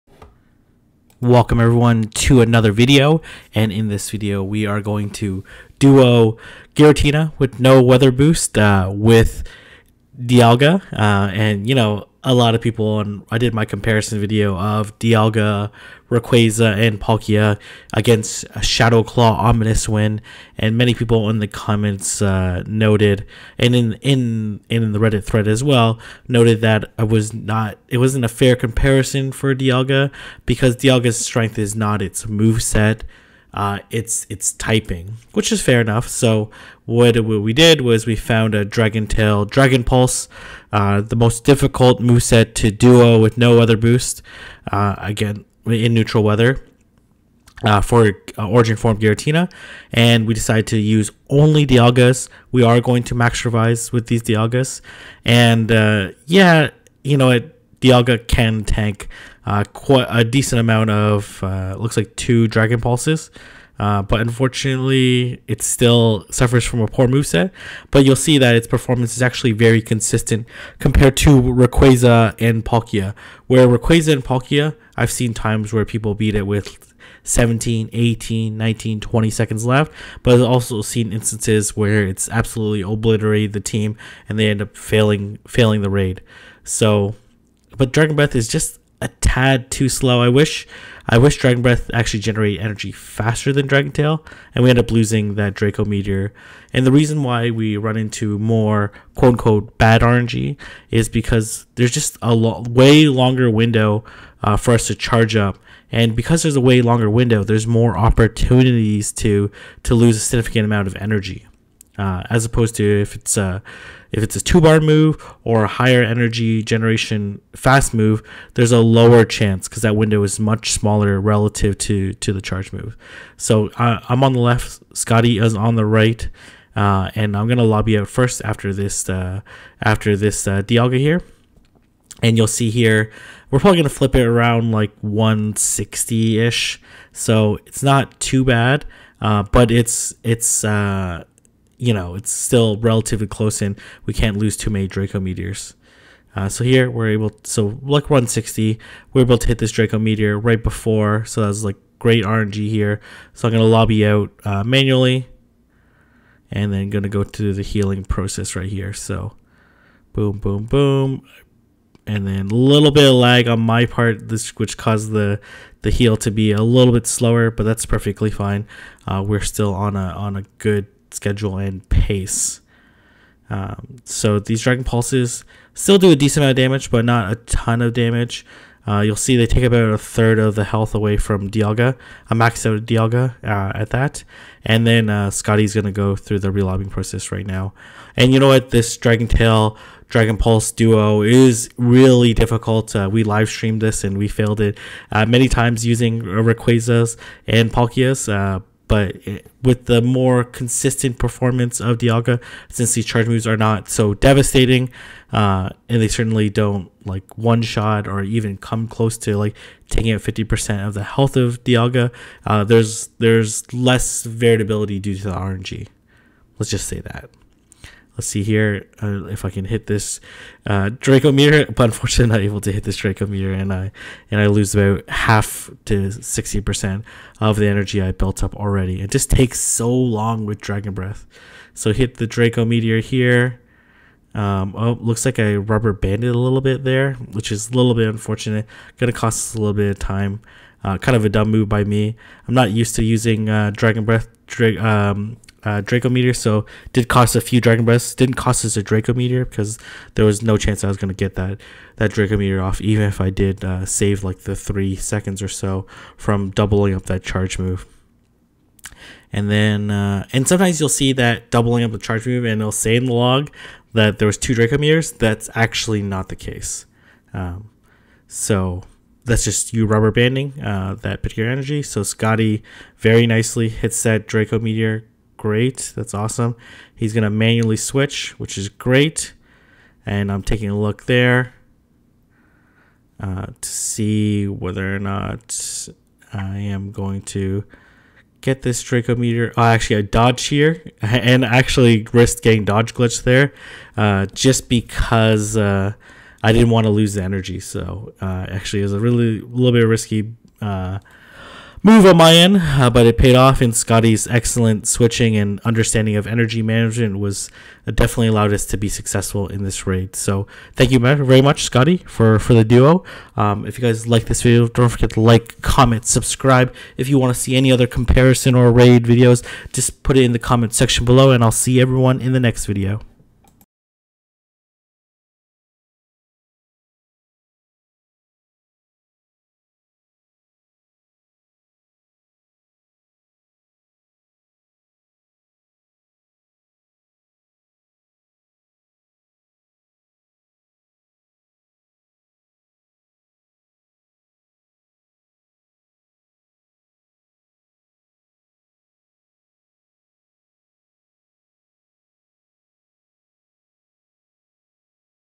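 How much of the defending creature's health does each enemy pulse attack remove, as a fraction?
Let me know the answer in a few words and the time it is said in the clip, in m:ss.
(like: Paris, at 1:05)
a third, at 2:59.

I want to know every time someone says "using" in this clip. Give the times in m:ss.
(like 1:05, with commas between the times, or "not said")
3:15, 4:03.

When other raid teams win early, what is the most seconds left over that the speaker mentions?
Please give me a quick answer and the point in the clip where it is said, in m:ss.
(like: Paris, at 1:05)
20, at 1:18.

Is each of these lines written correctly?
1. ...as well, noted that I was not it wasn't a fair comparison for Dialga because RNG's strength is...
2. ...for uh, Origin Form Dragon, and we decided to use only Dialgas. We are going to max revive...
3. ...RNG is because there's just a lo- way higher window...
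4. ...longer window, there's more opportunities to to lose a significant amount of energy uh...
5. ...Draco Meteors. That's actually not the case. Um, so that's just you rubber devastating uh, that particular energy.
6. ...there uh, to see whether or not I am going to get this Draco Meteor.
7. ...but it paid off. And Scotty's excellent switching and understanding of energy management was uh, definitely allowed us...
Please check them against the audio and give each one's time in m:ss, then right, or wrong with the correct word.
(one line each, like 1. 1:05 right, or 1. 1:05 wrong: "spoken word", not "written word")
1. 0:25 wrong: "Dialga", not "RNG"
2. 0:47 wrong: "Giratina", not "Dragon"
3. 1:40 wrong: "longer", not "higher"
4. 1:46 right
5. 4:24 wrong: "banding", not "devastating"
6. 4:41 right
7. 5:02 right.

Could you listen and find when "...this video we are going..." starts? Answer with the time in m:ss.
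0:03.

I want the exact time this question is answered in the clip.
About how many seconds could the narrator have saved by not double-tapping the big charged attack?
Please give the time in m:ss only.
4:14.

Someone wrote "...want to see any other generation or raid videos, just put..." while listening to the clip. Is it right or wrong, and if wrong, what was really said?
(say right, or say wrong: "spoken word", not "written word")
wrong: "comparison", not "generation".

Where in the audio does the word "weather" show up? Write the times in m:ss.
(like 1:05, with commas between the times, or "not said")
0:07, 0:46.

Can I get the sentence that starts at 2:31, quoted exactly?
So that's like great RNG here.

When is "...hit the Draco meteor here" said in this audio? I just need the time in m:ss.
3:51.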